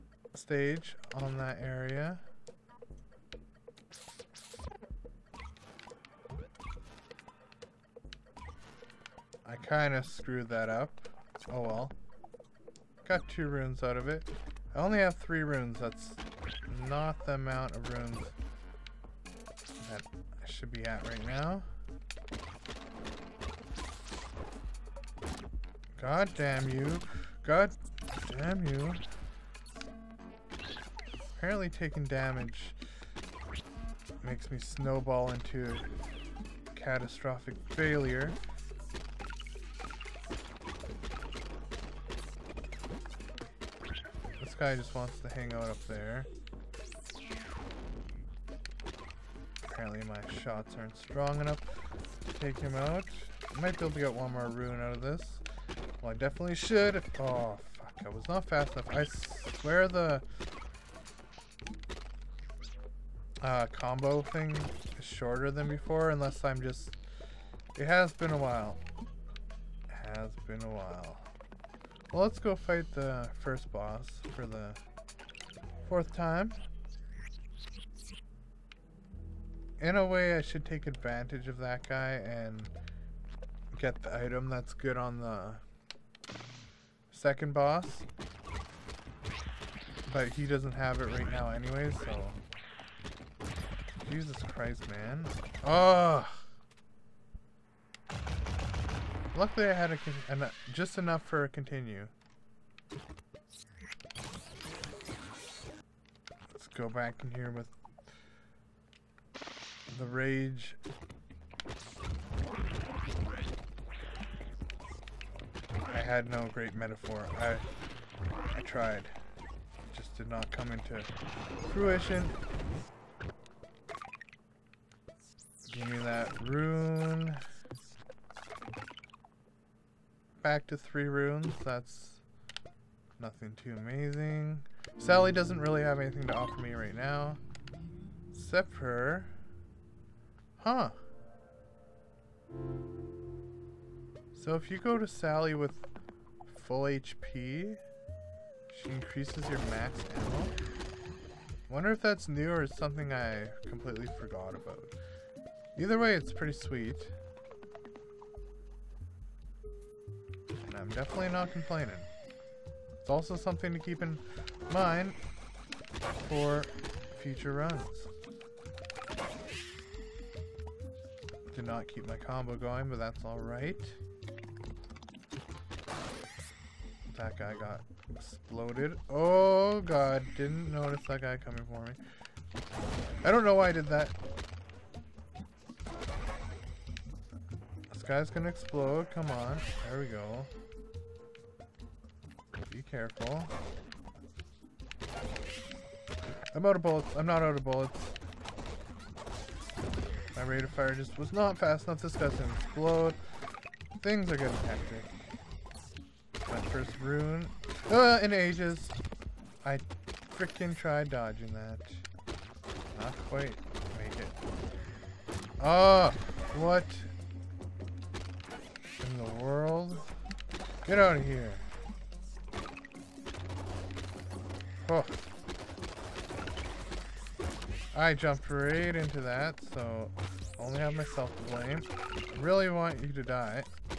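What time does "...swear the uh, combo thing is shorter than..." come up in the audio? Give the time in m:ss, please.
0:59.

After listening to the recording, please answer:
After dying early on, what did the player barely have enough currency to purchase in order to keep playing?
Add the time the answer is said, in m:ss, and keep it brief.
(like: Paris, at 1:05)
a continue, at 1:41.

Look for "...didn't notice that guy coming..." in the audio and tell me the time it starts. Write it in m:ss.
3:00.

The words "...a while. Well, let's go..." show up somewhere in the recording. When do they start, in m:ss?
1:10.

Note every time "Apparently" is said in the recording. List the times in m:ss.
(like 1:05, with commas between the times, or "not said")
0:31, 0:49.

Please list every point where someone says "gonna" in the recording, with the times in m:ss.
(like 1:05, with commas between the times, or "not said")
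3:08, 3:22.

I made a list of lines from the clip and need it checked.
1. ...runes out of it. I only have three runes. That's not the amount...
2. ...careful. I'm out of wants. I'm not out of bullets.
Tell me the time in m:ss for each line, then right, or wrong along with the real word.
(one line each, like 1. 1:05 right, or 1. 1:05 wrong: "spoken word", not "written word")
1. 0:13 right
2. 3:12 wrong: "bullets", not "wants".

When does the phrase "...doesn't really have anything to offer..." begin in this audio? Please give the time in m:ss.
2:15.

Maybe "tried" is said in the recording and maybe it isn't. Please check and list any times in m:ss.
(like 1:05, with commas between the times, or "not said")
1:58, 3:30.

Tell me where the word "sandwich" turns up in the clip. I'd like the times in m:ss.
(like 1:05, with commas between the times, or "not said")
not said.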